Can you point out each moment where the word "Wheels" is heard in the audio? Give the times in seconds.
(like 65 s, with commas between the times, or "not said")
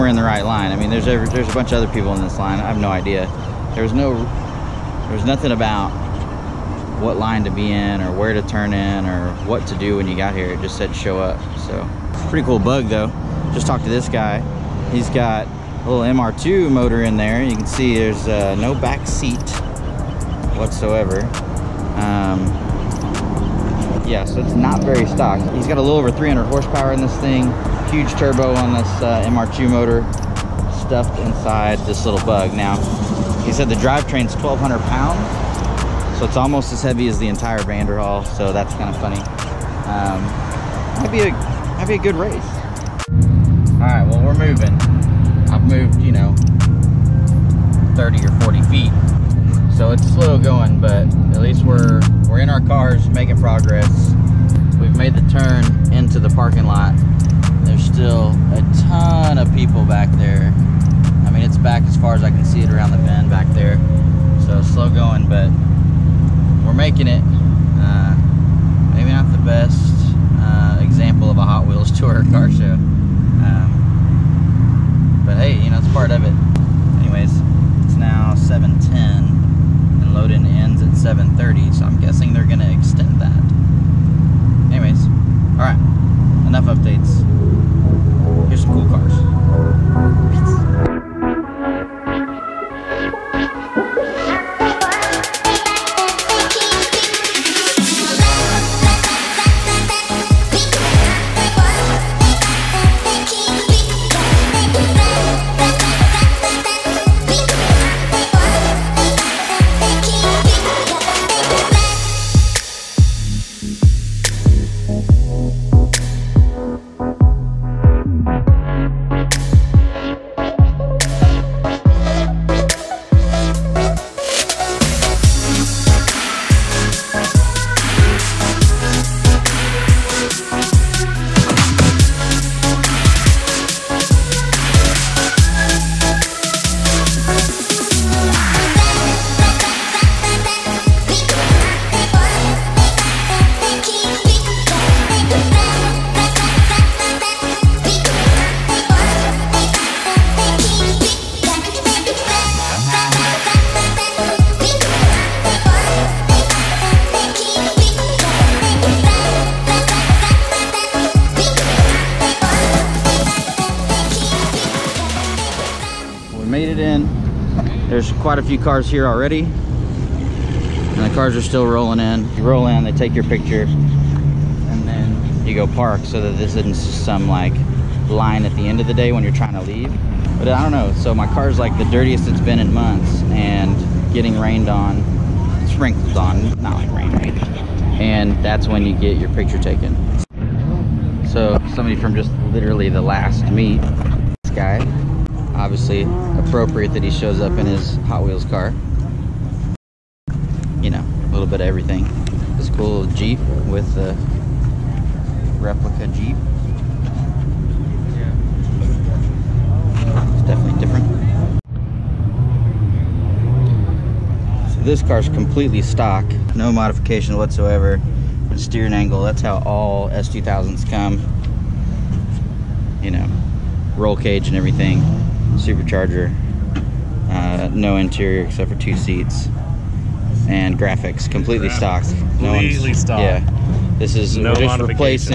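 71 s, 198 s.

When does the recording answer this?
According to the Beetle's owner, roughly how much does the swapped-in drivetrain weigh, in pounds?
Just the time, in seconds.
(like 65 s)
34 s.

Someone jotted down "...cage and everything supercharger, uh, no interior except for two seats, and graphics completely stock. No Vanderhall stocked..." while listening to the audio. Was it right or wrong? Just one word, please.
wrong.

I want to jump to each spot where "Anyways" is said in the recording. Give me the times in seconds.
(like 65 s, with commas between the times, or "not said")
77 s, 84 s.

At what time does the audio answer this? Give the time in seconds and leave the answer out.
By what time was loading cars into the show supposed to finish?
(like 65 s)
80 s.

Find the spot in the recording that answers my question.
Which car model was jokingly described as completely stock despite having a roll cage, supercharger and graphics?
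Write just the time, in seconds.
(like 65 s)
220 s.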